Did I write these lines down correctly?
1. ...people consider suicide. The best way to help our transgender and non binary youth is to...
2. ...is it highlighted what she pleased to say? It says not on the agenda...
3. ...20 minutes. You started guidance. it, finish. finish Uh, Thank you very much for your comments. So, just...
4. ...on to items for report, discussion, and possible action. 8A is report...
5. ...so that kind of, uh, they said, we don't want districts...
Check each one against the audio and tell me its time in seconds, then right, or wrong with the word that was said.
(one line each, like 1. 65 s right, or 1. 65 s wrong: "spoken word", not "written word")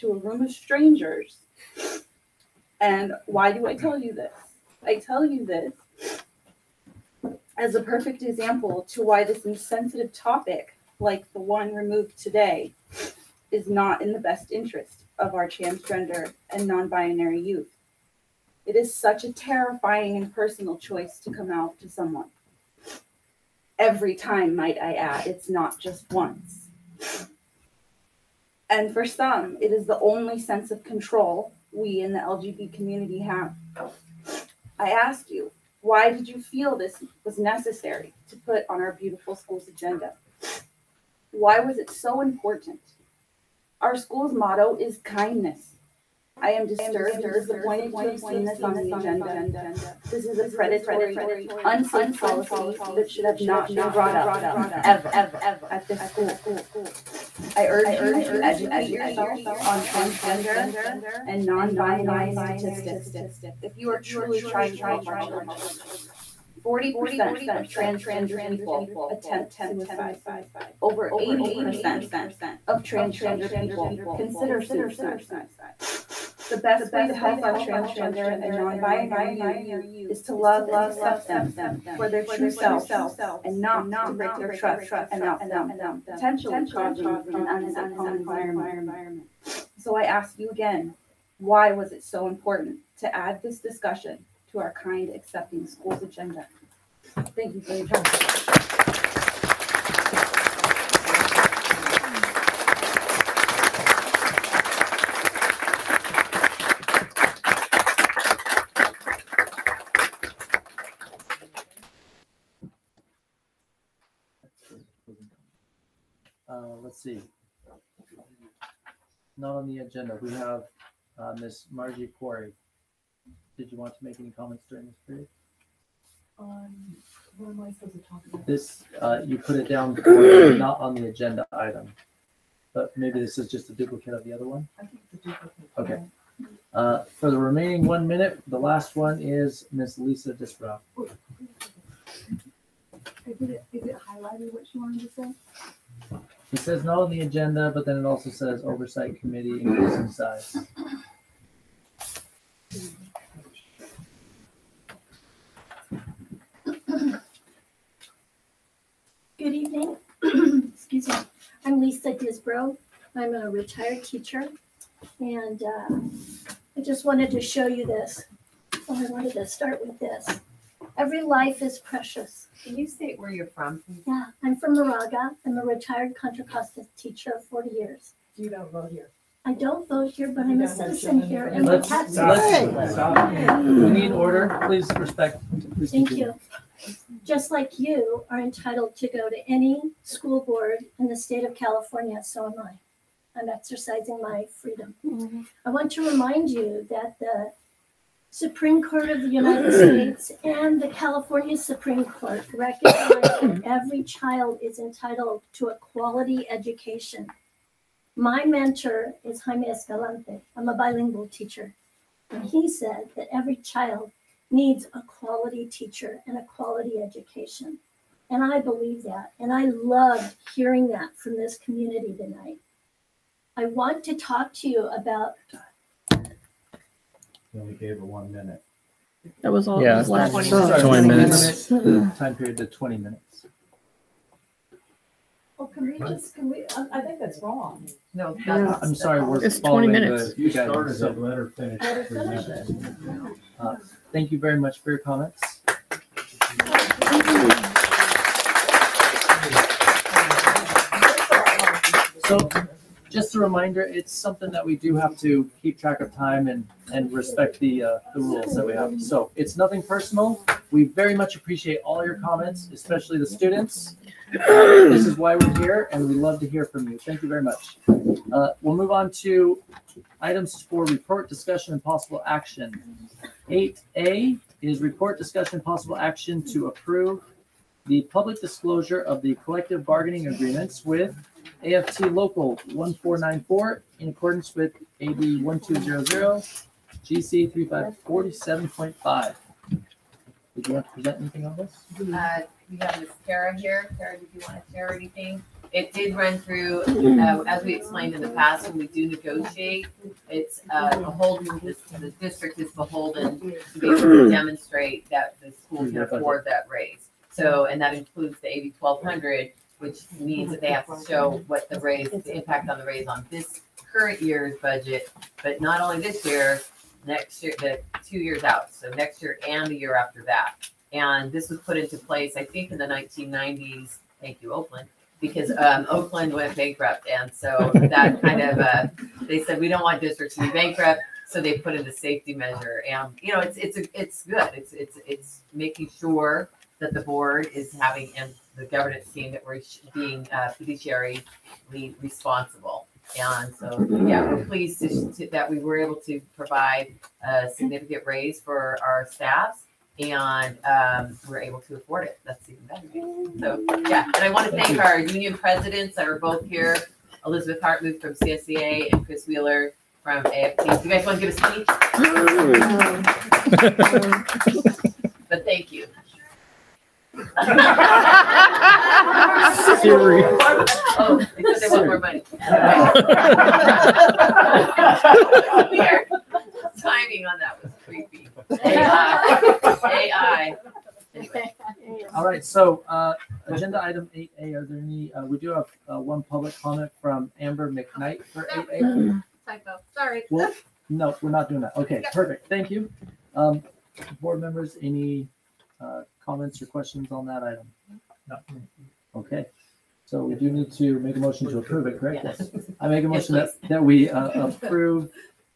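1. 73 s right
2. 143 s wrong: "wanted", not "pleased"
3. 239 s right
4. 268 s right
5. 327 s right.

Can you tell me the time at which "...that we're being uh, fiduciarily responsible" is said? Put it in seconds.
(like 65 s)
339 s.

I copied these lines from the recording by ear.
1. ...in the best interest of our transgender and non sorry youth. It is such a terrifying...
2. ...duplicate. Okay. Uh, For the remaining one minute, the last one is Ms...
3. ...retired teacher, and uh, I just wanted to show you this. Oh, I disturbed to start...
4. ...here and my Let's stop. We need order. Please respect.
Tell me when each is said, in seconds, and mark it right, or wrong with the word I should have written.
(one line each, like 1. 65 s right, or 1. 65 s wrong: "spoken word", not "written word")
1. 13 s wrong: "binary", not "sorry"
2. 135 s right
3. 163 s wrong: "wanted", not "disturbed"
4. 181 s right.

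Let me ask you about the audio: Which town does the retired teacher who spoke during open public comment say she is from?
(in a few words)
Moraga.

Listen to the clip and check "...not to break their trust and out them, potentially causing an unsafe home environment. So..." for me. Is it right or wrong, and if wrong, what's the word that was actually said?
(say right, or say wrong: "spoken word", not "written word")
right.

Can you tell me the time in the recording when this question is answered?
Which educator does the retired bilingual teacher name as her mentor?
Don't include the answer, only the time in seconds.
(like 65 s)
209 s.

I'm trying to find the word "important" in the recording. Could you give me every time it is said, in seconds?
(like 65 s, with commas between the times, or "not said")
42 s, 92 s.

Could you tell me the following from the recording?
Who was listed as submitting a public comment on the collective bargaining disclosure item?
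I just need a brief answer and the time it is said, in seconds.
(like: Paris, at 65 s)
Amber McKnight, at 387 s.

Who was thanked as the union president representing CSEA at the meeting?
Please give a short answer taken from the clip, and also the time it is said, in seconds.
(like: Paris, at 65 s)
Elizabeth Hartman, at 357 s.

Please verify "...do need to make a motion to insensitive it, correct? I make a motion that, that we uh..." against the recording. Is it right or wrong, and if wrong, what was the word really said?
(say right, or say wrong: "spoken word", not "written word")
wrong: "approve", not "insensitive".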